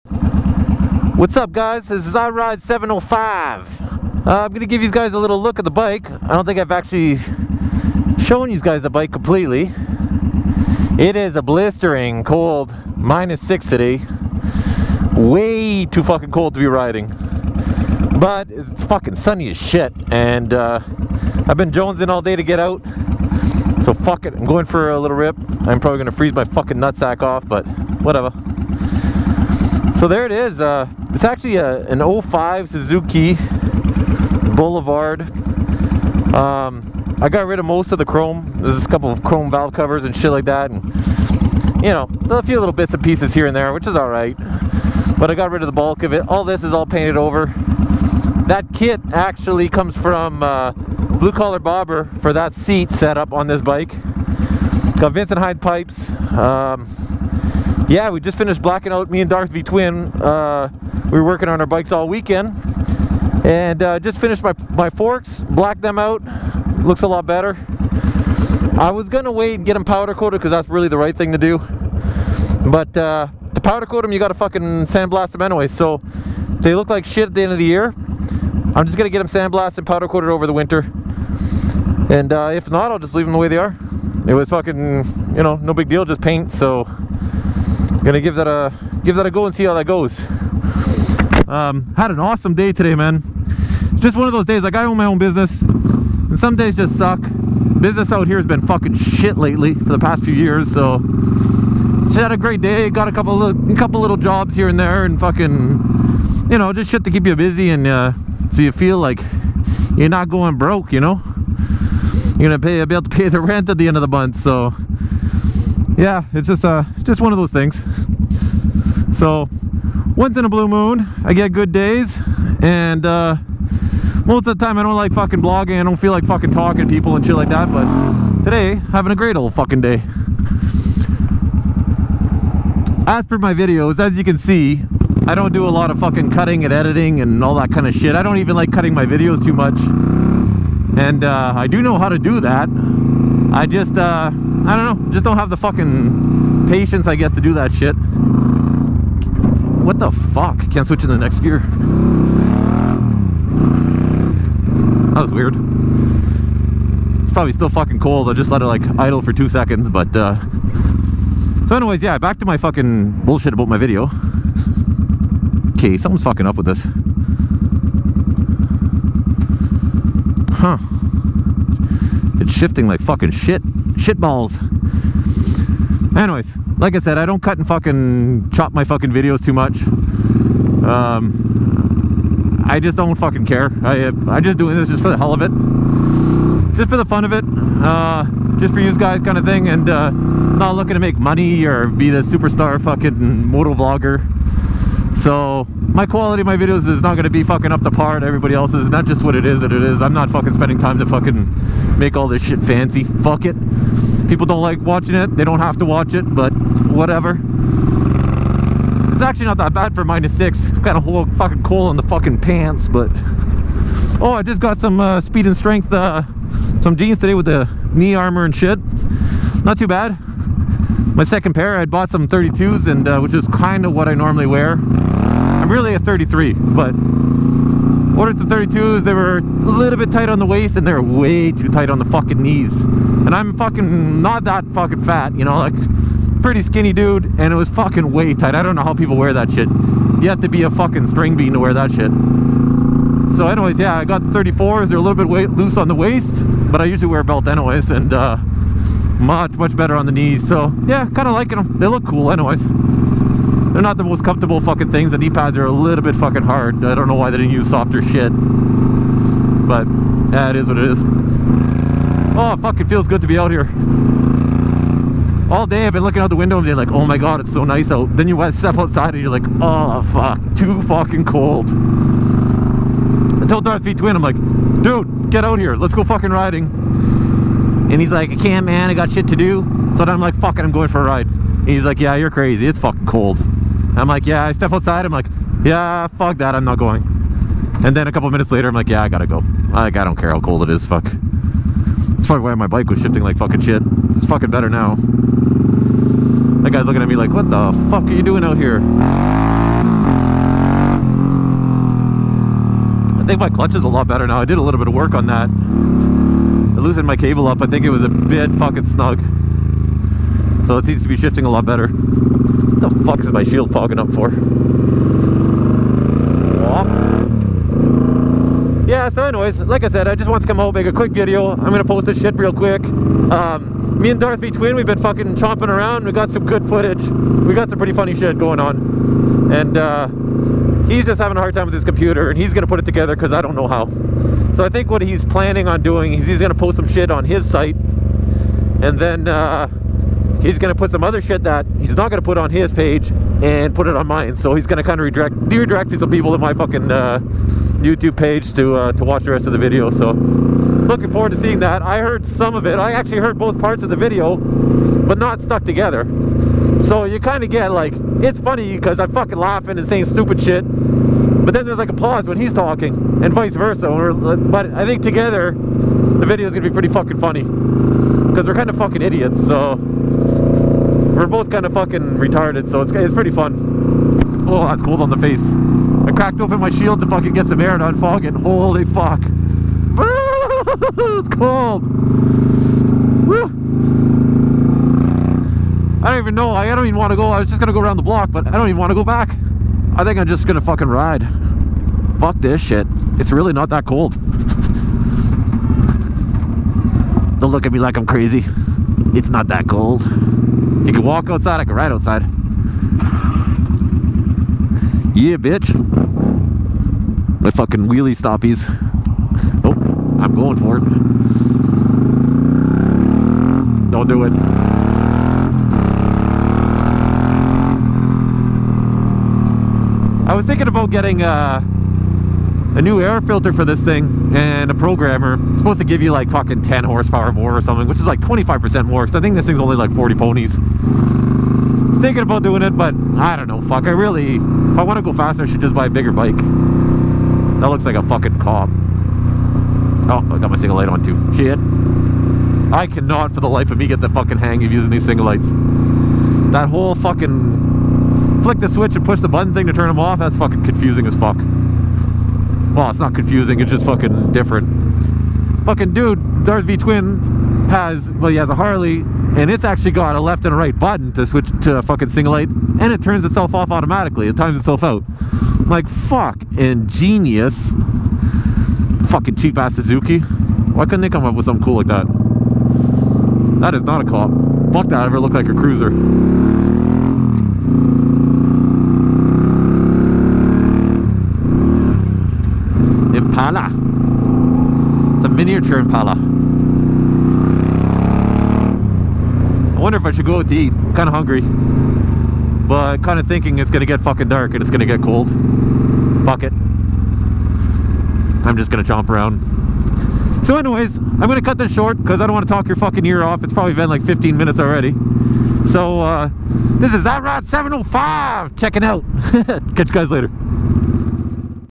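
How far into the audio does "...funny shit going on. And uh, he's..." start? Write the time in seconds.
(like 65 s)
327 s.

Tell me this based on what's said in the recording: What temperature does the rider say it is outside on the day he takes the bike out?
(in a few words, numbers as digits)
-6.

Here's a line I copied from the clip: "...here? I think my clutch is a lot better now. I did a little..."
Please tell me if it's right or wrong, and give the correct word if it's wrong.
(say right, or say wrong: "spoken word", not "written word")
right.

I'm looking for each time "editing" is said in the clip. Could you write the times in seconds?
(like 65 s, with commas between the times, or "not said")
136 s.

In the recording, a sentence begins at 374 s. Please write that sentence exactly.
Oh, that's cold on the face.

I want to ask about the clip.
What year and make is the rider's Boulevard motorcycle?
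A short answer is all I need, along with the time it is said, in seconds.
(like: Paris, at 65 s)
2005 Suzuki, at 32 s.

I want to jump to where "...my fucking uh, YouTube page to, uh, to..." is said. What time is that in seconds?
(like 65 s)
346 s.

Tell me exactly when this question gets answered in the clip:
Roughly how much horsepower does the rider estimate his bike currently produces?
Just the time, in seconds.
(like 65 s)
429 s.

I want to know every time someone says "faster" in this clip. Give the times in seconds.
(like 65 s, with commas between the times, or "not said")
435 s.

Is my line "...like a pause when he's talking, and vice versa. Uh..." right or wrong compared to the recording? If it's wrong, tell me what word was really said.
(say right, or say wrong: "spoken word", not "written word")
right.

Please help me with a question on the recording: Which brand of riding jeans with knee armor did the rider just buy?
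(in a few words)
Speed and Strength.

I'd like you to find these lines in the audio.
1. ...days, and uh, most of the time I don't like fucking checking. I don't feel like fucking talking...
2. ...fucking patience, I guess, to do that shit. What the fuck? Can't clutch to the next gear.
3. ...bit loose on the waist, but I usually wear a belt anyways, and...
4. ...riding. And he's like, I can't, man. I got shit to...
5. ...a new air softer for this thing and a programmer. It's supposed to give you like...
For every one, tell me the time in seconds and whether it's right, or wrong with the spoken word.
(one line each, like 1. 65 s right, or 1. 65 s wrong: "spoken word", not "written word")
1. 121 s wrong: "blogging", not "checking"
2. 145 s wrong: "switch", not "clutch"
3. 245 s right
4. 276 s right
5. 421 s wrong: "filter", not "softer".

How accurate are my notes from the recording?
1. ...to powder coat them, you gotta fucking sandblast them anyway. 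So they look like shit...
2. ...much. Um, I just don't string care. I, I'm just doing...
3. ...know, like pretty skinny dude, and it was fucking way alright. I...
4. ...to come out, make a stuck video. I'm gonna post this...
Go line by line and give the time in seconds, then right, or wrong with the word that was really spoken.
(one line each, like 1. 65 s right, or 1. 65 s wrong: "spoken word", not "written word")
1. 73 s right
2. 179 s wrong: "fucking", not "string"
3. 235 s wrong: "tight", not "alright"
4. 320 s wrong: "quick", not "stuck".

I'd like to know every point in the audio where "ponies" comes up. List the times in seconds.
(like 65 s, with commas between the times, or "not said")
430 s.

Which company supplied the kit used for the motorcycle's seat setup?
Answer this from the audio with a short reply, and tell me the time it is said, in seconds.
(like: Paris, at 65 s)
Blue Collar Bobber, at 50 s.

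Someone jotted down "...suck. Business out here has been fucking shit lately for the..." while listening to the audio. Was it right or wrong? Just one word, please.
right.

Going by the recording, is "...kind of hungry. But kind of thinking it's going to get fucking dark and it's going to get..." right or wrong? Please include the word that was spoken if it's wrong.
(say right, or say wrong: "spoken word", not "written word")
right.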